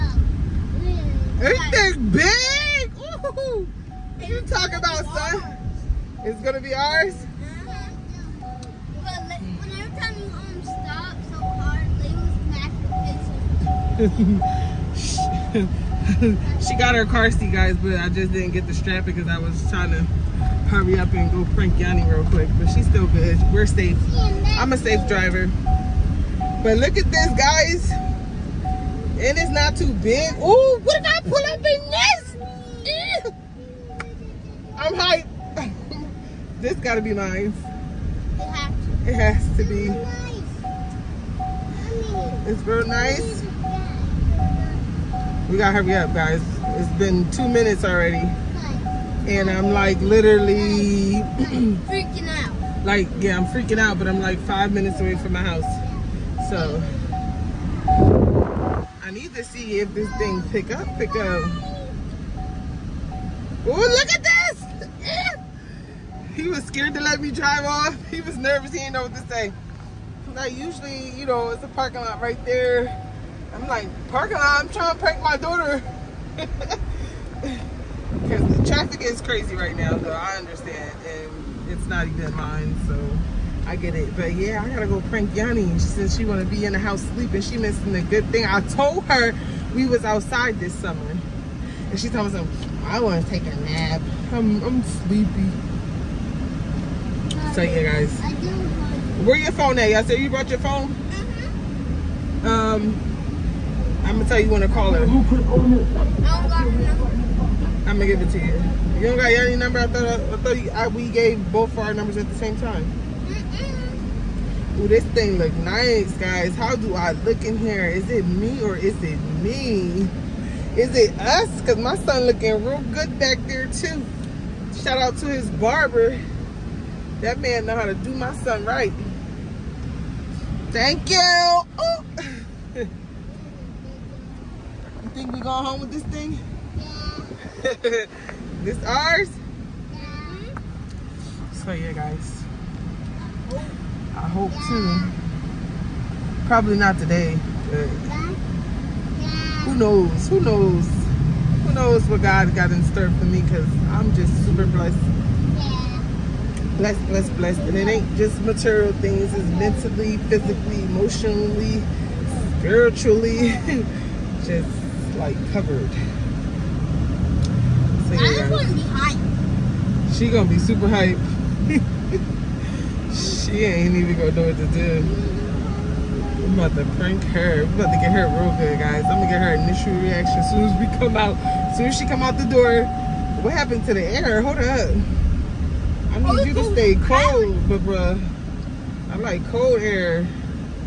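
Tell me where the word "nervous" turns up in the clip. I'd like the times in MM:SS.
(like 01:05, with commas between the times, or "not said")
01:08.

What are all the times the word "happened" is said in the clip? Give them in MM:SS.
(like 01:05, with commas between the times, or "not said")
03:03.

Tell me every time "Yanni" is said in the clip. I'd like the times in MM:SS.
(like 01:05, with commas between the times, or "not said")
00:21, 01:25, 01:49.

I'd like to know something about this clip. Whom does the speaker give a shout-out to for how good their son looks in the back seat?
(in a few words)
His barber.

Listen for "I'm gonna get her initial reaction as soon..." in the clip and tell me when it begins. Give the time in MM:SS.
02:59.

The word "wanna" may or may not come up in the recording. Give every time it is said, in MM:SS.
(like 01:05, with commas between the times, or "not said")
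01:26, 01:32.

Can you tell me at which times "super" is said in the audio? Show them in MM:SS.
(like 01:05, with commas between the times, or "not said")
02:34, 02:50.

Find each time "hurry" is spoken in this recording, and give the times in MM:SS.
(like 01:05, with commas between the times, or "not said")
00:20, 00:45.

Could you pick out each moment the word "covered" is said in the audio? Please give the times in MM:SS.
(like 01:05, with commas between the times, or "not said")
02:45.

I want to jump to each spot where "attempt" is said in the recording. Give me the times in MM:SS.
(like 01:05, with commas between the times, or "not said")
not said.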